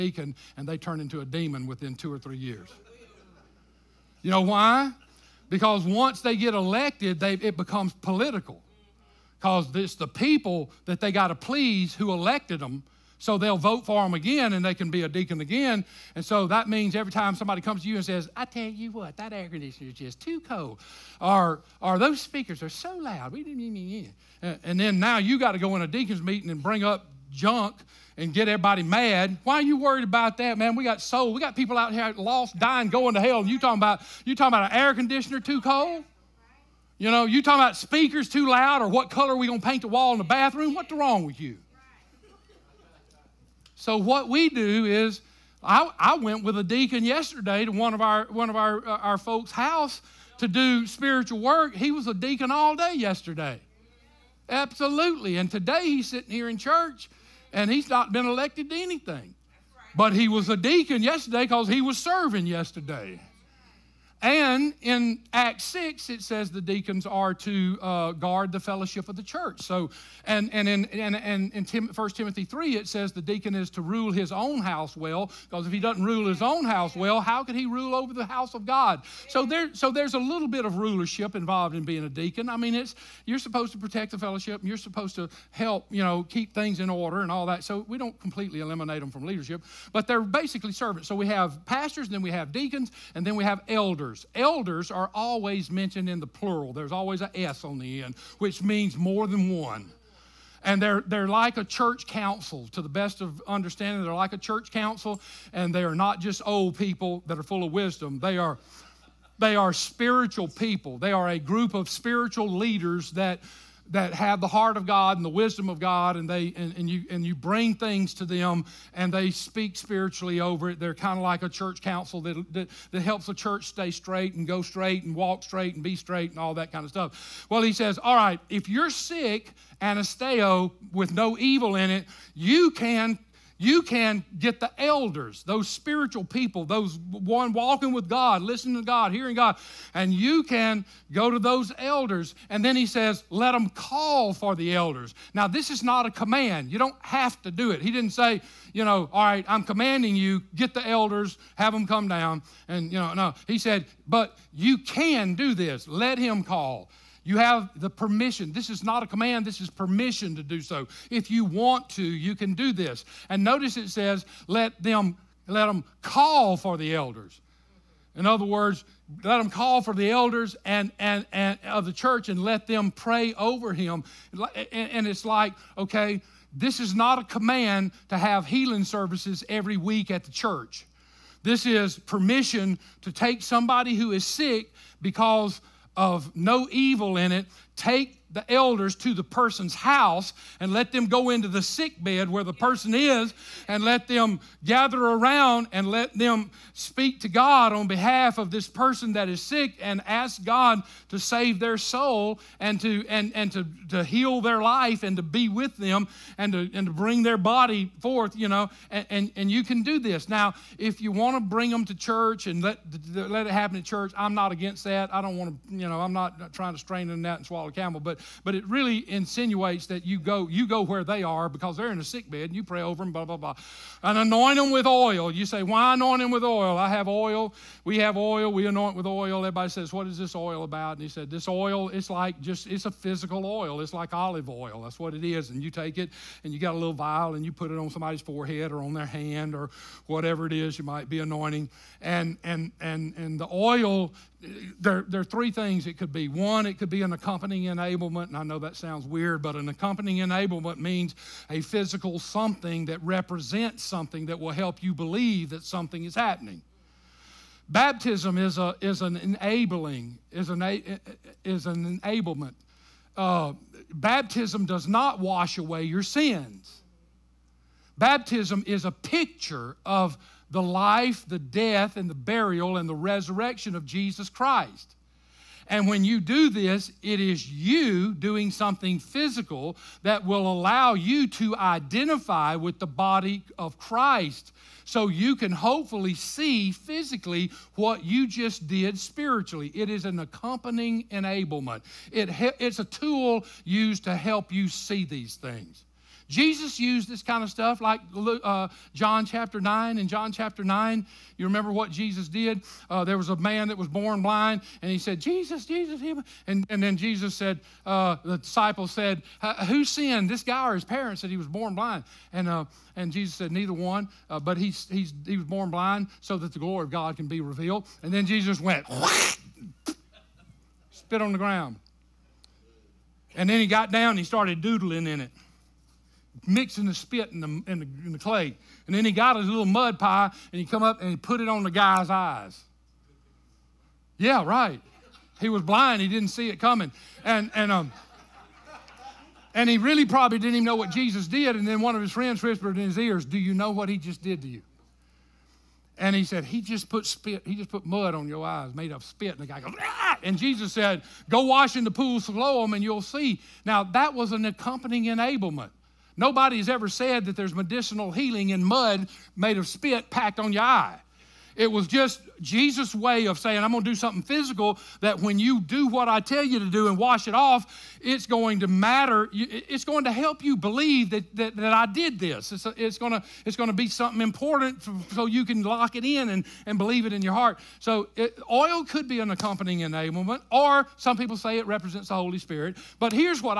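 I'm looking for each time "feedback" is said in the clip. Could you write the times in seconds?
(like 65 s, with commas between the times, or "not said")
not said.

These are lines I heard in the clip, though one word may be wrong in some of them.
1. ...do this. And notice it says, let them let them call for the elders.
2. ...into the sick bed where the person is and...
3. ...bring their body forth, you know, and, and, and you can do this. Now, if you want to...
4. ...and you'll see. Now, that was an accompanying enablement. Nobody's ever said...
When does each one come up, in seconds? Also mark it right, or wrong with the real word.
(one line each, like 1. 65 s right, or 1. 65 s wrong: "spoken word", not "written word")
1. 162 s right
2. 191 s right
3. 206 s right
4. 352 s right.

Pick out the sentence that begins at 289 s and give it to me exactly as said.
It is an accompanying enablement, it it's a tool used to help you see these things.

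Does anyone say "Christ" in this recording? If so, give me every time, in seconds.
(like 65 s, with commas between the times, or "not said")
274 s, 283 s.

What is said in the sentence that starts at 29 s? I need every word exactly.
Why are you worried about that, man?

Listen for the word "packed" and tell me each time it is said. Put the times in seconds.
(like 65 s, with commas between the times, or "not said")
360 s.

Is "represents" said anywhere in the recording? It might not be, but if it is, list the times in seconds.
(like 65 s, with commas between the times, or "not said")
253 s, 381 s.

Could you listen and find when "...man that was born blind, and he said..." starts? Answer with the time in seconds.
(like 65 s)
303 s.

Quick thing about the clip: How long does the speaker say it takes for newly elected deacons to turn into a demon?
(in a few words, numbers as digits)
2 or 3 years.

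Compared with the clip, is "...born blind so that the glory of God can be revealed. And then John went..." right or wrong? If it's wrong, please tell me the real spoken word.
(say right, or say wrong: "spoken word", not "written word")
wrong: "Jesus", not "John".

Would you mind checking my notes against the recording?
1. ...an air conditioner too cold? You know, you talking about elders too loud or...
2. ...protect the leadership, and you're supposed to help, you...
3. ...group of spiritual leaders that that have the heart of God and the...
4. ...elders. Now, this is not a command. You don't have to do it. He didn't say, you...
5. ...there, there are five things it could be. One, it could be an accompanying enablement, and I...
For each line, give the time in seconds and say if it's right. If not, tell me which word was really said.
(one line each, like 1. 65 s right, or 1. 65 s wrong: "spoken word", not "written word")
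1. 34 s wrong: "speakers", not "elders"
2. 83 s wrong: "fellowship", not "leadership"
3. 111 s right
4. 144 s right
5. 244 s wrong: "three", not "five".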